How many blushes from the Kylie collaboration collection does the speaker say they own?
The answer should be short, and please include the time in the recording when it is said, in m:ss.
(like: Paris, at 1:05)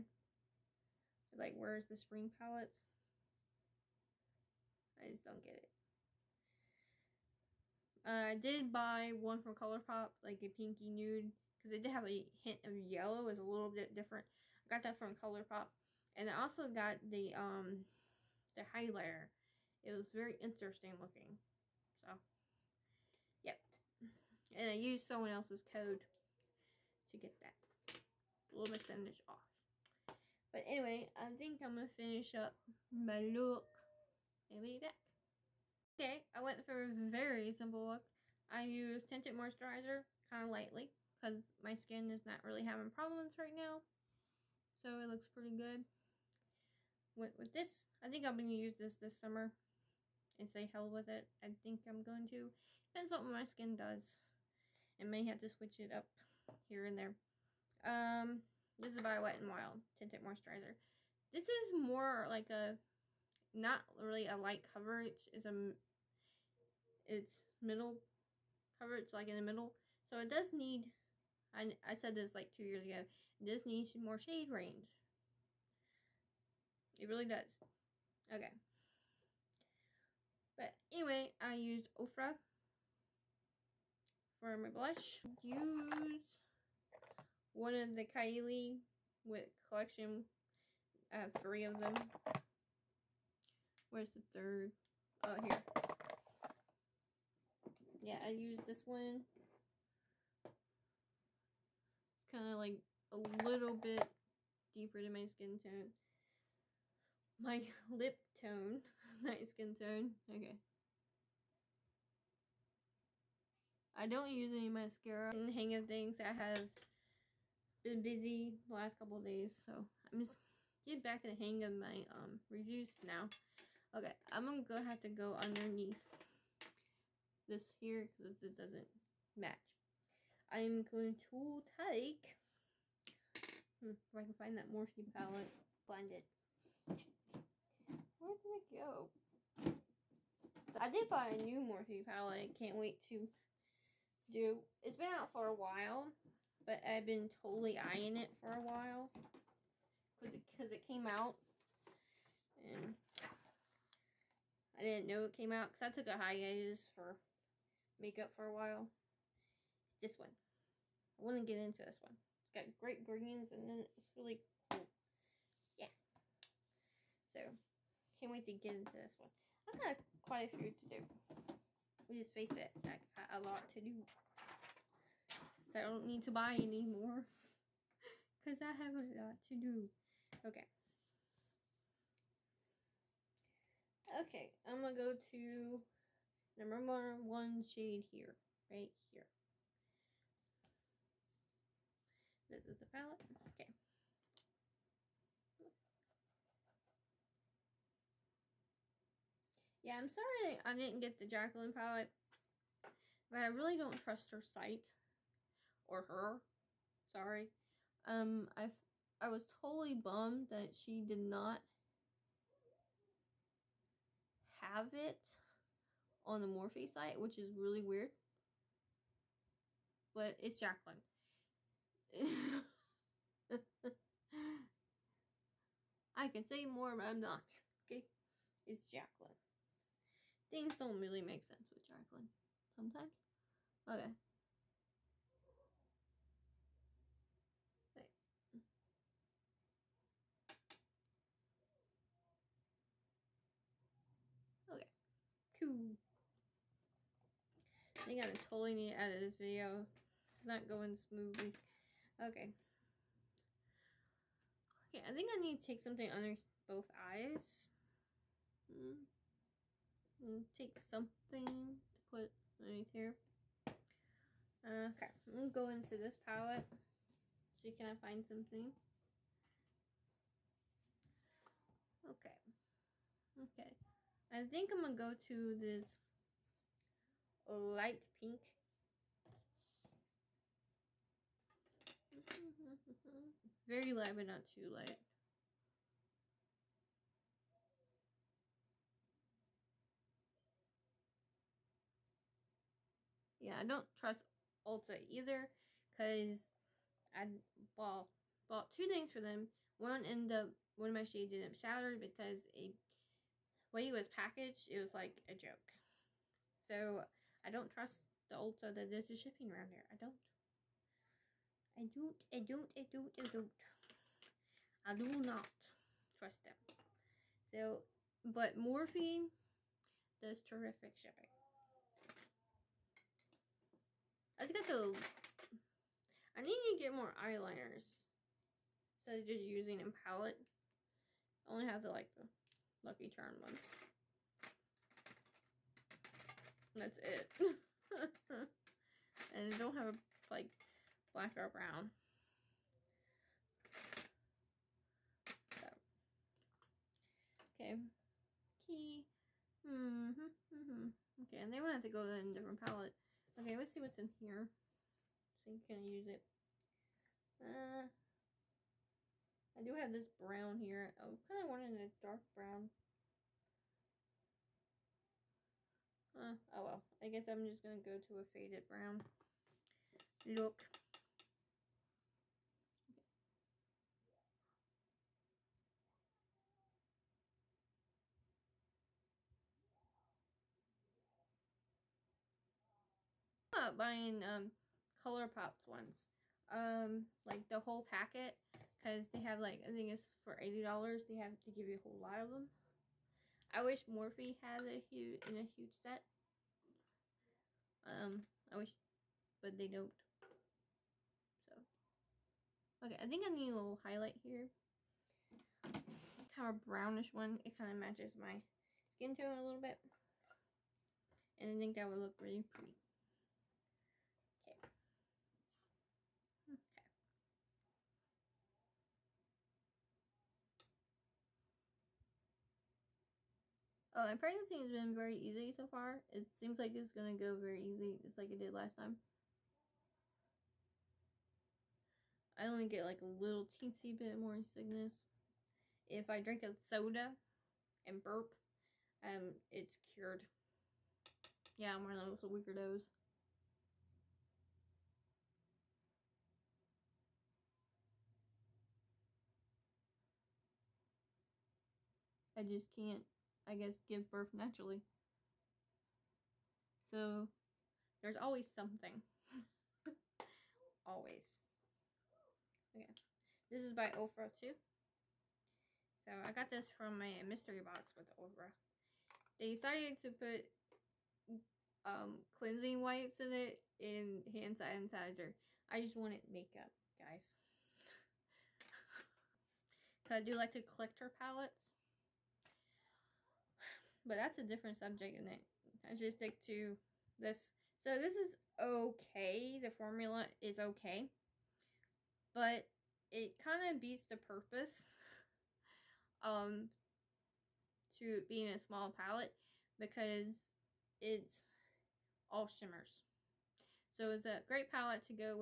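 3, at 1:31.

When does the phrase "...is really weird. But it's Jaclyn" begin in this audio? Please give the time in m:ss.
3:37.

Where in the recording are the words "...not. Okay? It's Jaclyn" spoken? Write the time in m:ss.
3:47.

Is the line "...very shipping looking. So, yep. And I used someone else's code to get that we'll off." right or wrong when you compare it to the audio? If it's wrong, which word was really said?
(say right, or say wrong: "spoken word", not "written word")
wrong: "interesting", not "shipping".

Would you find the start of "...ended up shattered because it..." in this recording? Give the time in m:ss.
5:01.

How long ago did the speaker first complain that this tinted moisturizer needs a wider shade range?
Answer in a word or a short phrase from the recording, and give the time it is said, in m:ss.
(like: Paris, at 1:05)
2 years, at 1:12.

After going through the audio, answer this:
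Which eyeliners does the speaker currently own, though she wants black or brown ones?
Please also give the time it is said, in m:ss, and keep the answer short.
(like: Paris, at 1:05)
Lucky Charm ones, at 5:32.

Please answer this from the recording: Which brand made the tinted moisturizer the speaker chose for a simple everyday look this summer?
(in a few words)
Wet n Wild.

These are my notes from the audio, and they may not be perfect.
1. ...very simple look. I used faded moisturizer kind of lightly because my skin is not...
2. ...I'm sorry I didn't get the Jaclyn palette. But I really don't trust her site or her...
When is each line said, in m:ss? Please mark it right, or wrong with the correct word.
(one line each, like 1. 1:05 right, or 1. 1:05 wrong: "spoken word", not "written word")
1. 0:36 wrong: "tinted", not "faded"
2. 3:19 right.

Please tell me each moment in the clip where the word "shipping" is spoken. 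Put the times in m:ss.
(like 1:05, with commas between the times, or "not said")
5:09, 5:20.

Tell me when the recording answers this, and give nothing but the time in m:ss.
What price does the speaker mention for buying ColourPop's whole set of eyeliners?
6:30.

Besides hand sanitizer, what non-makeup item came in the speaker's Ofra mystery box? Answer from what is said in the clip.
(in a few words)
Cleansing wipes.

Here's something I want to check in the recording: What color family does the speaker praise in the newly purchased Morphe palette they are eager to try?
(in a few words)
Greens.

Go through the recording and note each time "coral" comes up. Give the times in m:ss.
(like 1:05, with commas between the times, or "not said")
not said.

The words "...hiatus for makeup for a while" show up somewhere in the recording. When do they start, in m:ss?
2:36.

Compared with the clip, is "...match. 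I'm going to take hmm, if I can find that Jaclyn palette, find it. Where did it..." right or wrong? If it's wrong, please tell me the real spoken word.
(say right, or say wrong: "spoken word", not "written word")
wrong: "Morphe", not "Jaclyn".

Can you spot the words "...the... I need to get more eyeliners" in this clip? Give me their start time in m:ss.
5:24.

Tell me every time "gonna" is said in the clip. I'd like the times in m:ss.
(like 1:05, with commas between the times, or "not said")
2:04, 4:25, 4:34.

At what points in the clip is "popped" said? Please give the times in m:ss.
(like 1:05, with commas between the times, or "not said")
not said.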